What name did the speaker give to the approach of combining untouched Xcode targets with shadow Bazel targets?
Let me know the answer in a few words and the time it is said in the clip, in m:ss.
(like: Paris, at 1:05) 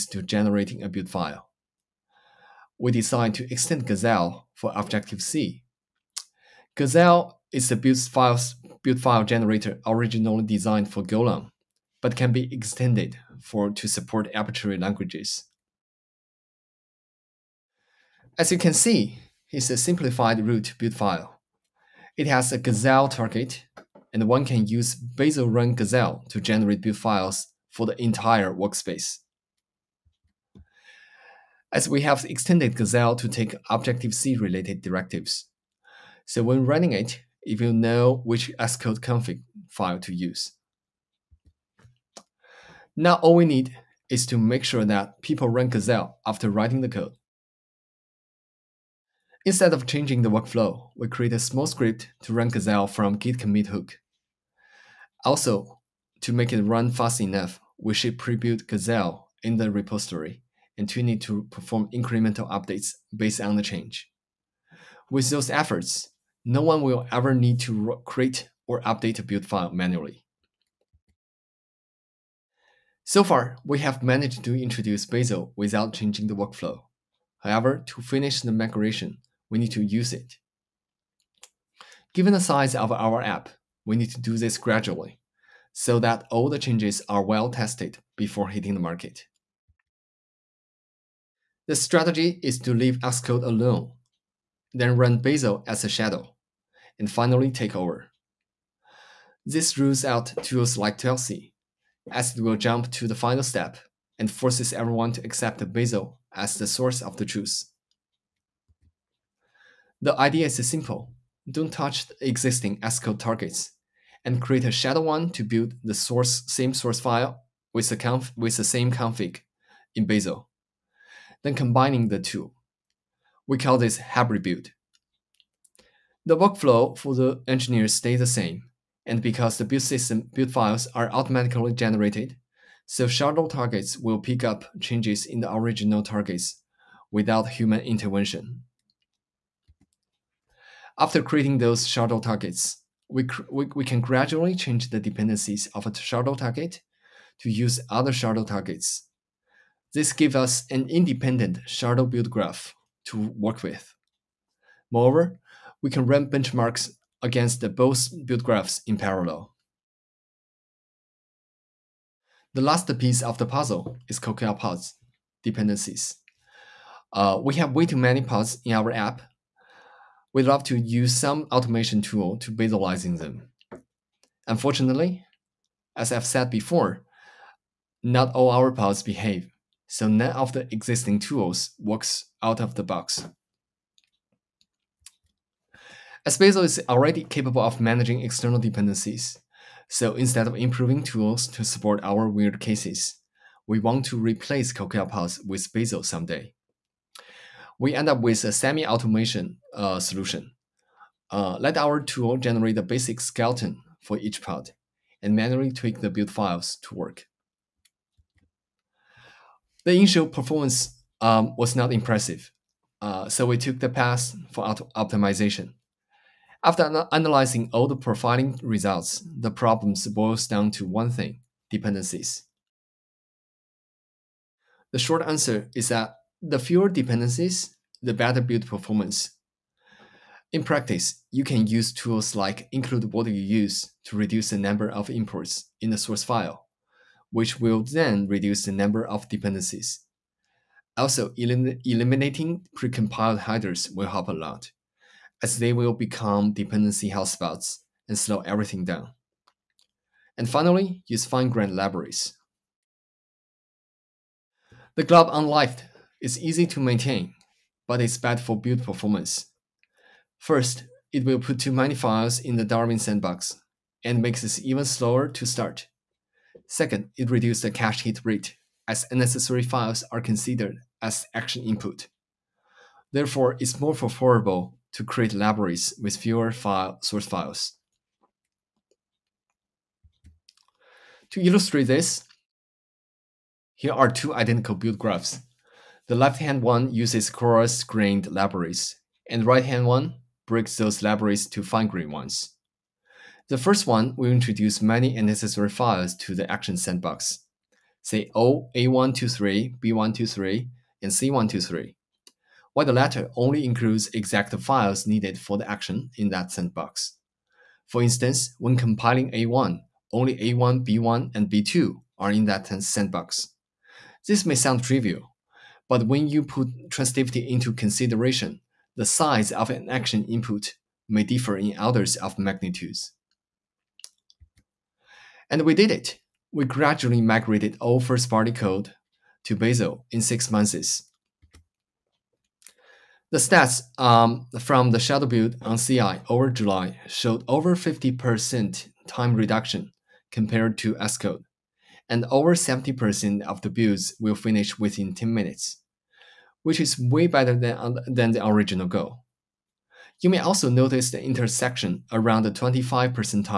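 hybrid build, at 2:03.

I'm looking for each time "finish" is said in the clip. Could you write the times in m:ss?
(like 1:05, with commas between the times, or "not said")
1:18, 5:44.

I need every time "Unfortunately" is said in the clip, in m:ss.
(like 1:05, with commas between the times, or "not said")
2:54.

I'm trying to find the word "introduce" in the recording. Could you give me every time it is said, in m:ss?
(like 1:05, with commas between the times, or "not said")
1:14, 4:54.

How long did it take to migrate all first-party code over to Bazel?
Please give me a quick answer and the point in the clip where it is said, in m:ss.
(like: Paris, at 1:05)
6 months, at 5:30.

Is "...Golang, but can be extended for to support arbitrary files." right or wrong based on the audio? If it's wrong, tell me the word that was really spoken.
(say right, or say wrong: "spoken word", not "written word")
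wrong: "languages", not "files".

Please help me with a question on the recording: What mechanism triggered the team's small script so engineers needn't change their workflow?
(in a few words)
git commit hook.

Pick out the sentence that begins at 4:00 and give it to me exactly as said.
Also, elim eliminating precompiled headers will help a lot, as they will become dependency hotspots and slow everything down.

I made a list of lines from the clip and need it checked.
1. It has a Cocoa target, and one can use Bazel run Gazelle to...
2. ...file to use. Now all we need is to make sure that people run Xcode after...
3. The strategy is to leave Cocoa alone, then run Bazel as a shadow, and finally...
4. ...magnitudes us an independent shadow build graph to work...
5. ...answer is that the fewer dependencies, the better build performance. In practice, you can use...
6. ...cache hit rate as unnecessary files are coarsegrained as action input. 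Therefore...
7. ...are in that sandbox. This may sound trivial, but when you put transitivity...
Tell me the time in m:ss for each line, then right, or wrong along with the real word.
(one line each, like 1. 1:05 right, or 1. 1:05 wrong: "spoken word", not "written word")
1. 0:22 wrong: "Gazelle", not "Cocoa"
2. 0:39 wrong: "Gazelle", not "Xcode"
3. 1:31 wrong: "Xcode", not "Cocoa"
4. 2:30 wrong: "gives", not "magnitudes"
5. 3:45 right
6. 4:27 wrong: "considered", not "coarsegrained"
7. 5:12 right.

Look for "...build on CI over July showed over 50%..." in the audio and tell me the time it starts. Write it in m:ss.
5:35.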